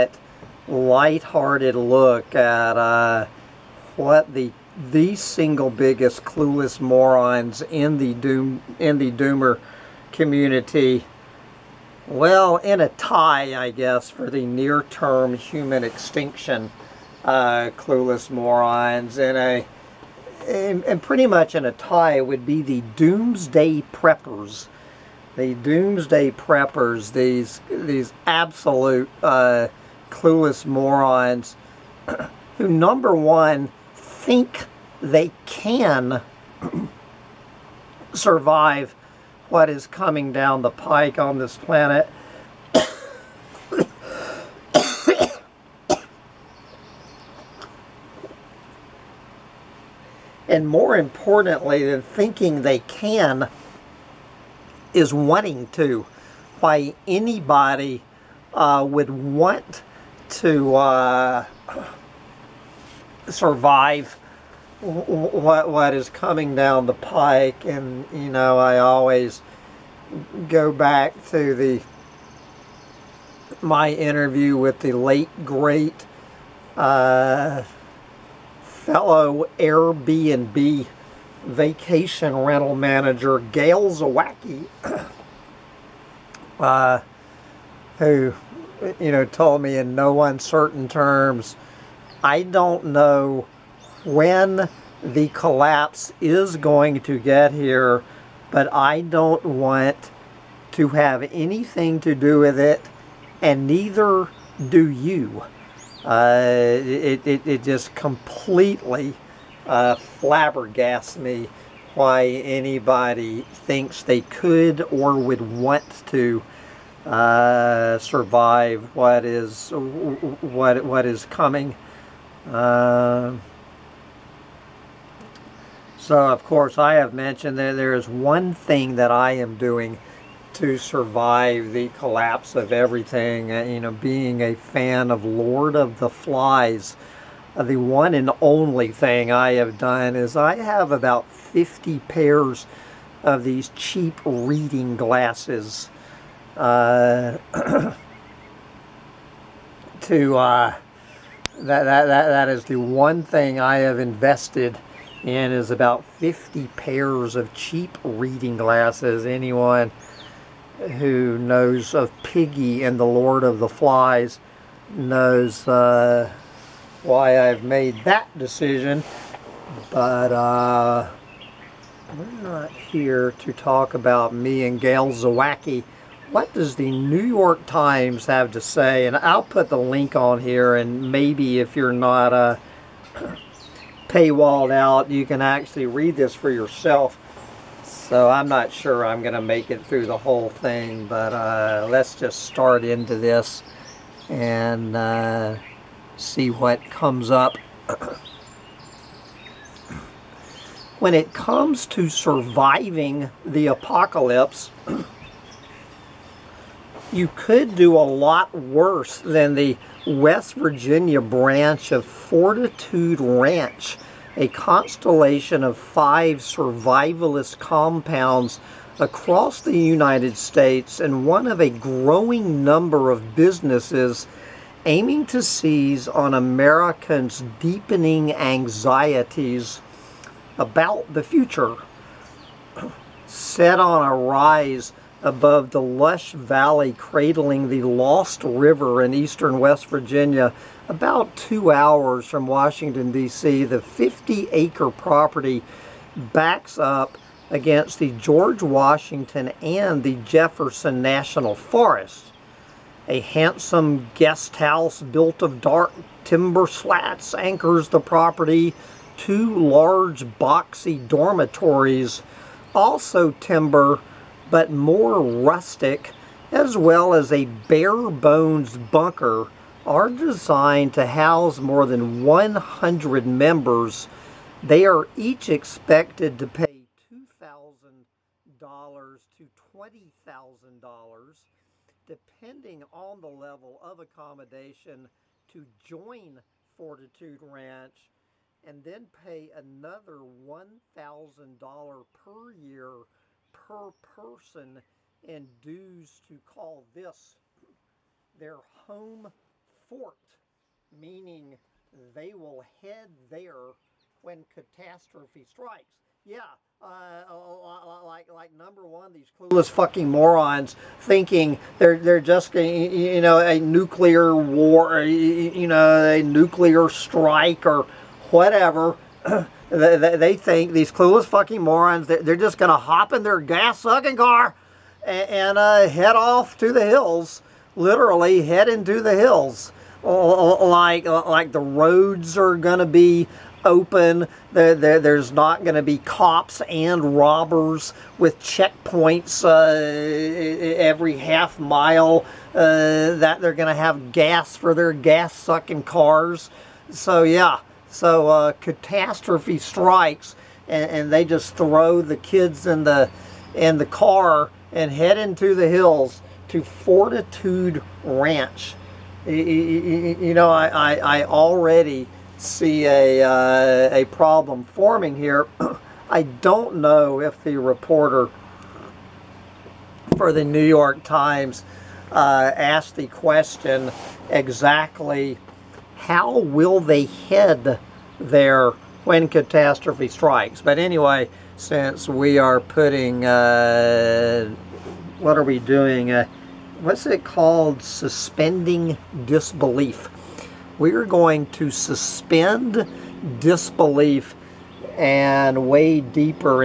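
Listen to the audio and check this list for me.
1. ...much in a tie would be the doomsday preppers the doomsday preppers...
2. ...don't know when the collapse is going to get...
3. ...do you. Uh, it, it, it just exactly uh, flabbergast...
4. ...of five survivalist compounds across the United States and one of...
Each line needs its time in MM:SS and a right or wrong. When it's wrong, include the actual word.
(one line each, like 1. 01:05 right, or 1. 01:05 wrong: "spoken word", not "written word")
1. 00:21 right
2. 01:32 right
3. 01:44 wrong: "completely", not "exactly"
4. 03:35 right.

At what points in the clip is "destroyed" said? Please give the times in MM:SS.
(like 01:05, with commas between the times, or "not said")
not said.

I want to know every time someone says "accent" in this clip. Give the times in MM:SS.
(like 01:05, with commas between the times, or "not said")
not said.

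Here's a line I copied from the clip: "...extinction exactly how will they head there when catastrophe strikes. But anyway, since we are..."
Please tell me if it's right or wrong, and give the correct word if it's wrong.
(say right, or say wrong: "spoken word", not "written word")
wrong: "question", not "extinction".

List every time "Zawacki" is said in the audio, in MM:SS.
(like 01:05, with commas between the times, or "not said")
01:23, 02:55.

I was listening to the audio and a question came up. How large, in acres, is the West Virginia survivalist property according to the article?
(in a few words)
50 acres.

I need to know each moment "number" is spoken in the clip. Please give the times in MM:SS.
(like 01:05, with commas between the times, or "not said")
00:32, 03:42, 05:08.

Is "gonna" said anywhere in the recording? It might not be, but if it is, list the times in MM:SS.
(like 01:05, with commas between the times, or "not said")
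05:22, 05:32.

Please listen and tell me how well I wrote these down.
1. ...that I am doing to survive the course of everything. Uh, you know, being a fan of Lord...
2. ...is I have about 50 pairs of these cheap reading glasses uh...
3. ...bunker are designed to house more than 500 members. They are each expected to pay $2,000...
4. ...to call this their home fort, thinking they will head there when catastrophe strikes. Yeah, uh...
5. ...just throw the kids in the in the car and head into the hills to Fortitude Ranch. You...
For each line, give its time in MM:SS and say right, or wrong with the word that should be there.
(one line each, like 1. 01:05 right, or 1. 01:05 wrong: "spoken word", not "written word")
1. 02:08 wrong: "collapse", not "course"
2. 02:20 right
3. 04:28 wrong: "100", not "500"
4. 04:56 wrong: "meaning", not "thinking"
5. 05:51 right.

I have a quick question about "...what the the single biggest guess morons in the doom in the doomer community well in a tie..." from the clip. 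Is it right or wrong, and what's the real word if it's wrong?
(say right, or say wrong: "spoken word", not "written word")
wrong: "clueless", not "guess".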